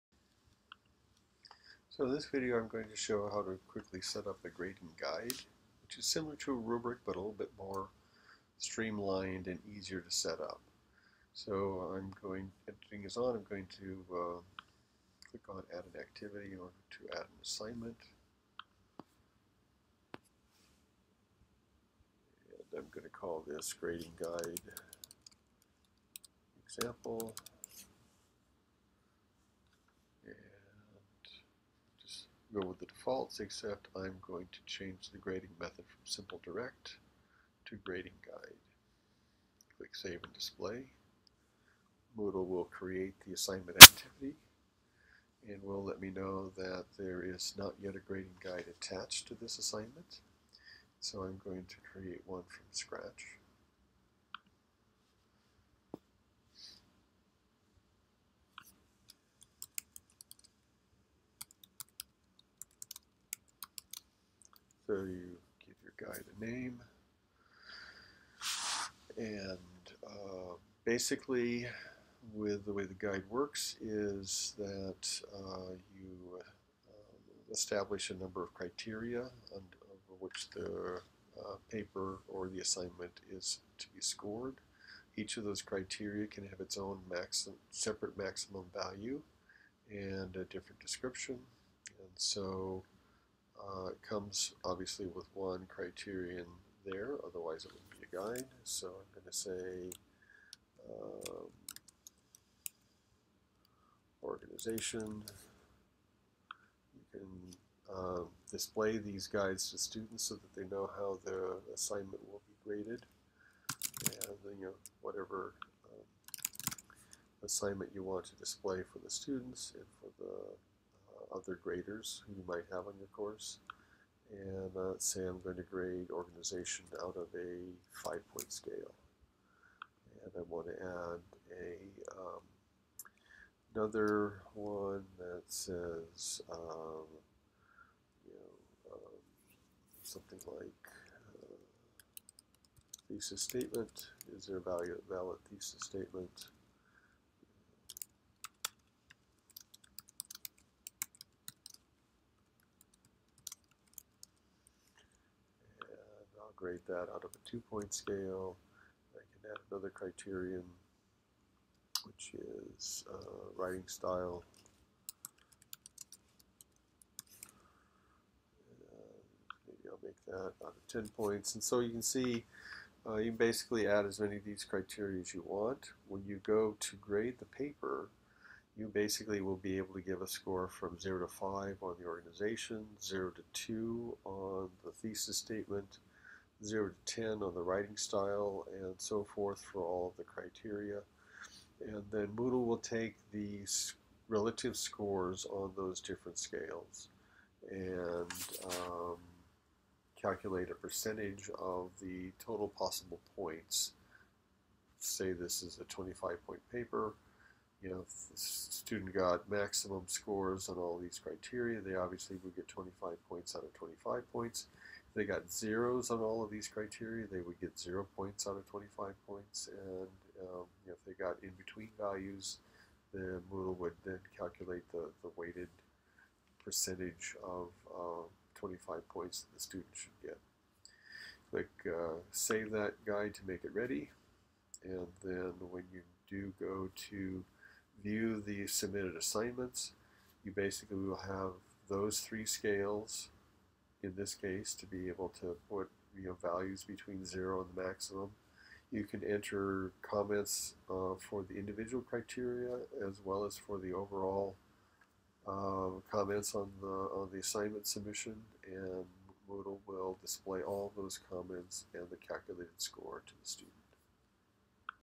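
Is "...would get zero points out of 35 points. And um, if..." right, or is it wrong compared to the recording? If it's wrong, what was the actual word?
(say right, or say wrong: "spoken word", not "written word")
wrong: "25", not "35".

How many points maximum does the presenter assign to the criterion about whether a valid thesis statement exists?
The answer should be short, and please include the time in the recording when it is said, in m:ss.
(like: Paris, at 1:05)
2, at 2:37.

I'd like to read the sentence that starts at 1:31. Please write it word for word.
And so uh, it comes obviously with one criterion there, otherwise it wouldn't be a guide.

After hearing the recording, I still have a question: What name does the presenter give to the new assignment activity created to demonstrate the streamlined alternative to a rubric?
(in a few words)
grading guide example.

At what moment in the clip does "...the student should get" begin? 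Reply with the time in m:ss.
3:49.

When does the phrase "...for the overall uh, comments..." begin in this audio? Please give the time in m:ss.
4:13.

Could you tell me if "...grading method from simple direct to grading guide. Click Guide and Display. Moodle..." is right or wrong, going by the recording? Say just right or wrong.
wrong.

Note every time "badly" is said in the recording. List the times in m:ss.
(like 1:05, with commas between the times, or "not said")
not said.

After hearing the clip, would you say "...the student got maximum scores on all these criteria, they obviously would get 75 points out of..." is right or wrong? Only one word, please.
wrong.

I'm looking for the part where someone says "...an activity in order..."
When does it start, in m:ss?
0:15.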